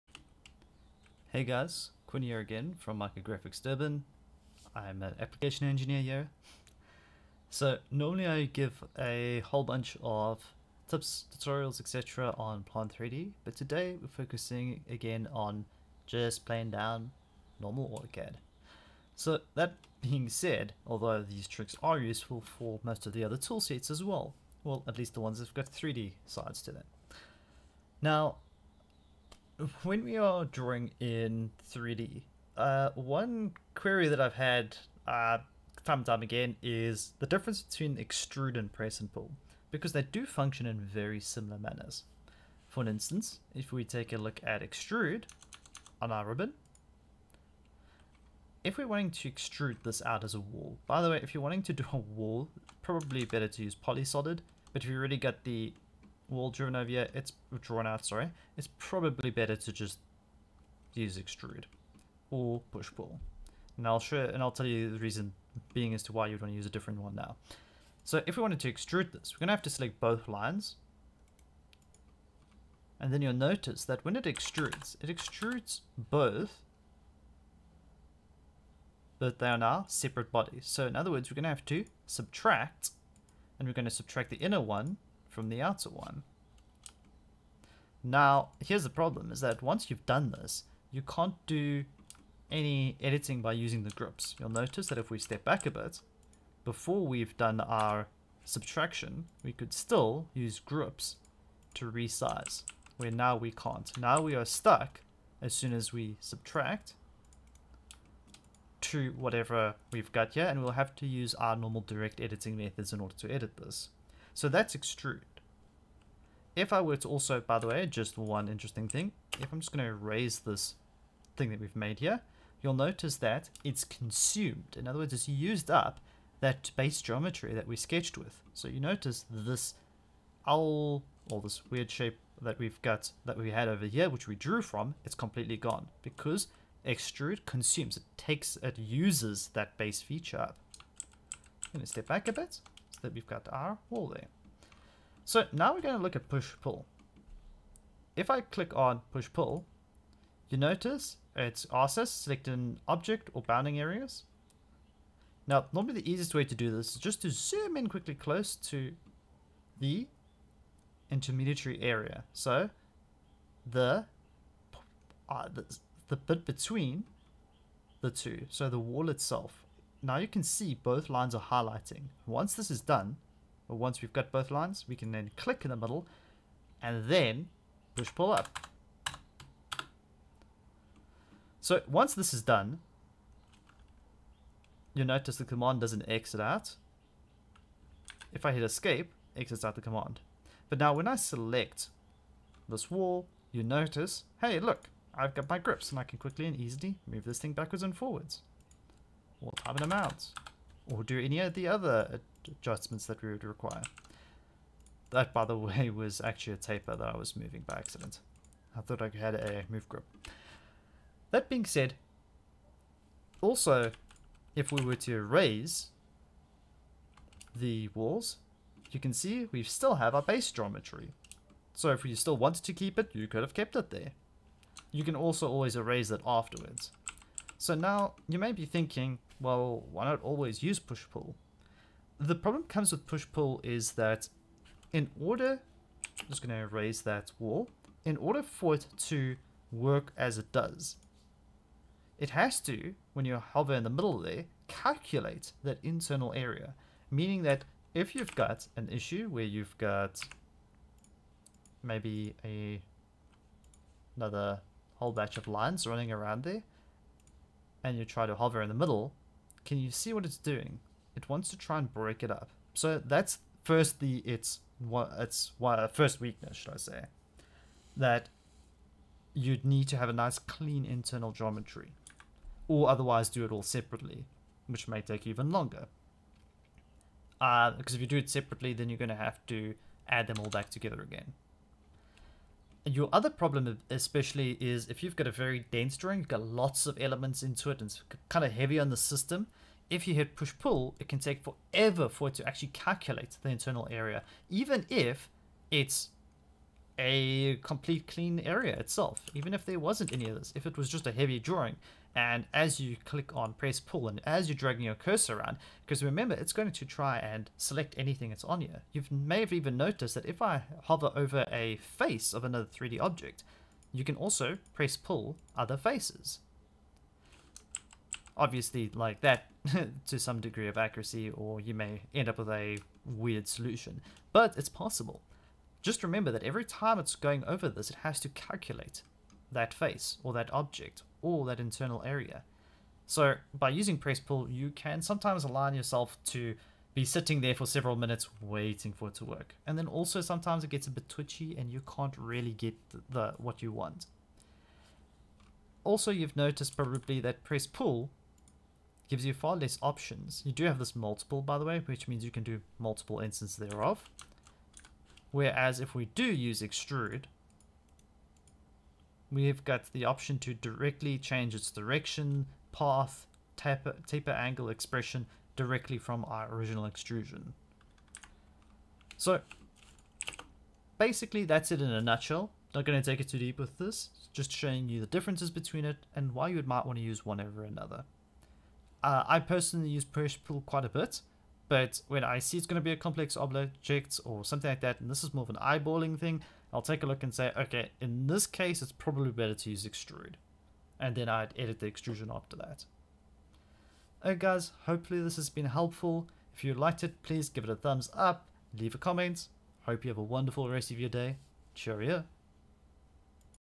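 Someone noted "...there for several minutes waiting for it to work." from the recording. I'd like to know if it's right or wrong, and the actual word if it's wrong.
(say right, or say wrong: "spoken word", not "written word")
right.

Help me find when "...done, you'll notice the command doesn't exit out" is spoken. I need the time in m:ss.
3:02.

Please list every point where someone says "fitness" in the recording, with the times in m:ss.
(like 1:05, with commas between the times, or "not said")
not said.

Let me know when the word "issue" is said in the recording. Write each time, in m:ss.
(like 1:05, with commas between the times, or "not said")
4:08.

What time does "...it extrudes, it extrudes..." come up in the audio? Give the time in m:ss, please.
1:14.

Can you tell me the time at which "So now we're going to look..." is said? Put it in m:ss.
2:25.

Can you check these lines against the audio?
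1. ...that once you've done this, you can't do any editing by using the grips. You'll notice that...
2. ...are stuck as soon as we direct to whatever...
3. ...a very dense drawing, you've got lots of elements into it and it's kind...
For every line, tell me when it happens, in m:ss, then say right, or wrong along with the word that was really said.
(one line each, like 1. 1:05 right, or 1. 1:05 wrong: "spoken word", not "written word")
1. 1:29 right
2. 1:44 wrong: "subtract", not "direct"
3. 4:45 right.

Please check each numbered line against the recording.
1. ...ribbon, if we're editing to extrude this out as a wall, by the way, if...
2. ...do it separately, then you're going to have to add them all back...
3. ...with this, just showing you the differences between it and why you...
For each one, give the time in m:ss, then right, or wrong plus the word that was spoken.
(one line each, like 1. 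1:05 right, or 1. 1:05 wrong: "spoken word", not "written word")
1. 0:46 wrong: "wanting", not "editing"
2. 4:38 right
3. 6:13 right.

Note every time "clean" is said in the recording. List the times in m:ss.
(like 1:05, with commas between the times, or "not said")
4:30, 4:58.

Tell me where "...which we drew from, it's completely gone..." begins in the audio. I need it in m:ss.
2:14.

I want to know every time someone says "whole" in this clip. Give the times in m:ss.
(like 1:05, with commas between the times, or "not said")
0:09, 4:14.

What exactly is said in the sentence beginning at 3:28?
I thought I had a move grip.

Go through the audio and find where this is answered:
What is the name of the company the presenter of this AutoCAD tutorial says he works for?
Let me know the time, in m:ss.
0:02.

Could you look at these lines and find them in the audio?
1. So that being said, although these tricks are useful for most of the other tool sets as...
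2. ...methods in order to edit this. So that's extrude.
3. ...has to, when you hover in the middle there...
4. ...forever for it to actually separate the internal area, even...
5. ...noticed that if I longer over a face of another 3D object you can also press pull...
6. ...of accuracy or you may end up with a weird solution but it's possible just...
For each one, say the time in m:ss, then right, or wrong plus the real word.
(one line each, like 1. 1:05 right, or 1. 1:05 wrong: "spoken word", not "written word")
1. 0:19 right
2. 1:52 right
3. 4:02 right
4. 4:51 wrong: "calculate", not "separate"
5. 5:09 wrong: "hover", not "longer"
6. 5:20 right.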